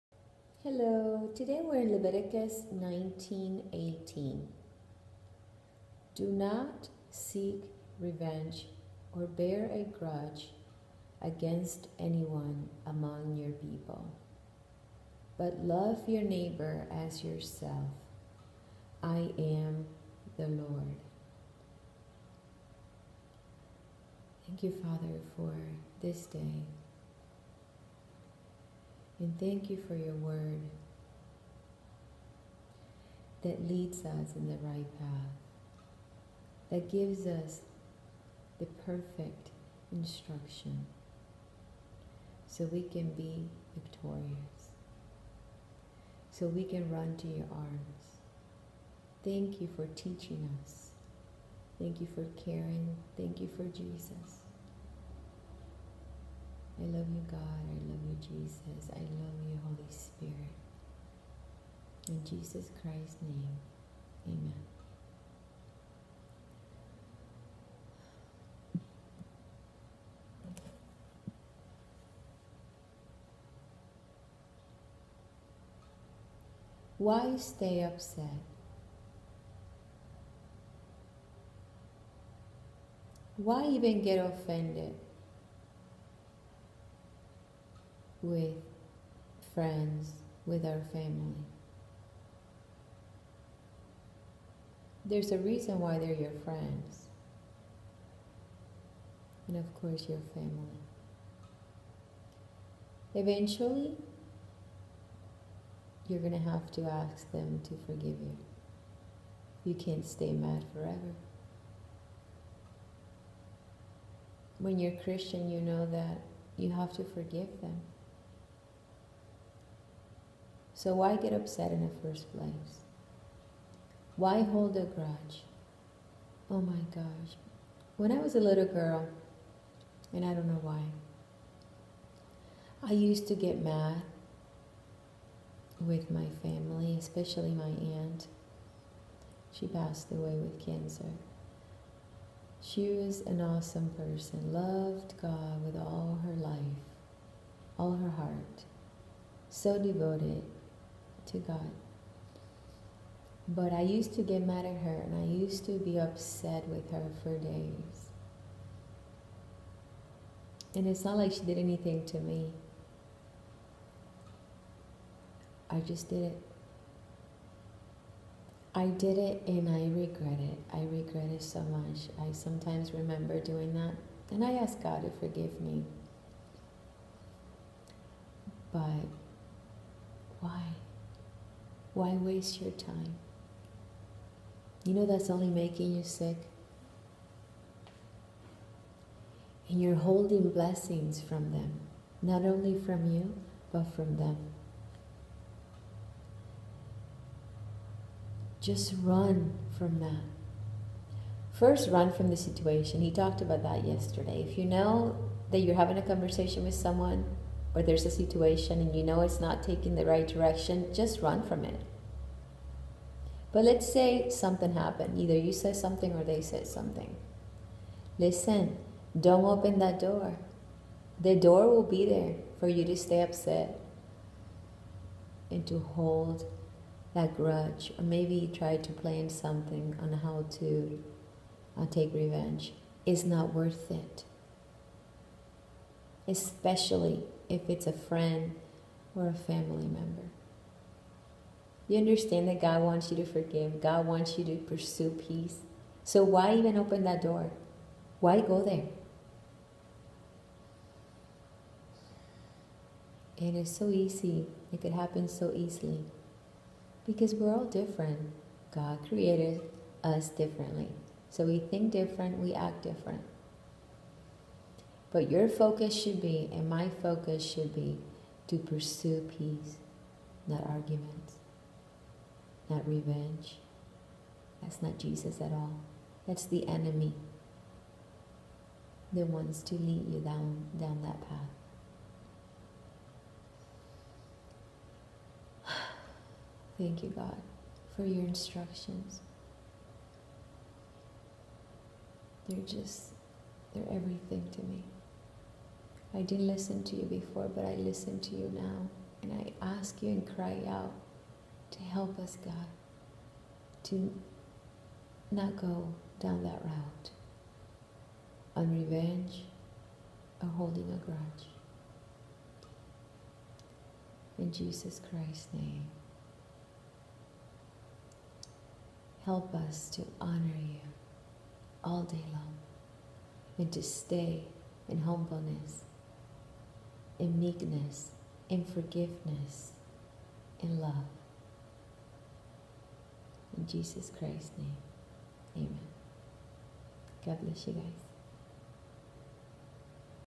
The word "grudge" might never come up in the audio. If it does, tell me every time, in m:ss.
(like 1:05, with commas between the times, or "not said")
0:09, 2:04, 3:47, 5:11.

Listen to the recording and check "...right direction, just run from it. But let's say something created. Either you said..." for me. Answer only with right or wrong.
wrong.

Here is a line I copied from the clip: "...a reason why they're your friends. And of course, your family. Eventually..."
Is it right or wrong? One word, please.
right.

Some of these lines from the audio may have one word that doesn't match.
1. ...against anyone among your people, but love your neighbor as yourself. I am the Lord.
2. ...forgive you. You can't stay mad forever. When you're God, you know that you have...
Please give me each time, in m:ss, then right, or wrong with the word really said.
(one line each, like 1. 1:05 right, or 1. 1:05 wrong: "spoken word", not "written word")
1. 0:11 right
2. 1:47 wrong: "Christian", not "God".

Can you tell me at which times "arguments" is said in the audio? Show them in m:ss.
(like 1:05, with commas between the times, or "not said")
4:30.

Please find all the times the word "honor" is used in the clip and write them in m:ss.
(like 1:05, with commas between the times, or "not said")
5:20.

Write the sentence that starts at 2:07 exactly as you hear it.
When I was a little girl, and I don't know why, I used to get mad with my family, especially my aunt.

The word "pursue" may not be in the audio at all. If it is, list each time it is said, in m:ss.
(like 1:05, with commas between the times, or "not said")
4:04, 4:28.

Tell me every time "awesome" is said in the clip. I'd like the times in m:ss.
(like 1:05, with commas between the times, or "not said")
2:23.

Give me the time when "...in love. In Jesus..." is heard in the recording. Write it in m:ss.
5:30.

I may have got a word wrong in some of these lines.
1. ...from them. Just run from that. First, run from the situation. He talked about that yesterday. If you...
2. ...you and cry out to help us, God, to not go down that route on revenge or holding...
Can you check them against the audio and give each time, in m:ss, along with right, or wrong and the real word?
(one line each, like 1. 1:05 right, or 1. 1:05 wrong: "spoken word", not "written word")
1. 3:13 right
2. 5:00 right.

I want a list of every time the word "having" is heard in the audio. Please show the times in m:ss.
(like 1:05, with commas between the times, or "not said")
3:25.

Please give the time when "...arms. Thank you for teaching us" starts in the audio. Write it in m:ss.
0:47.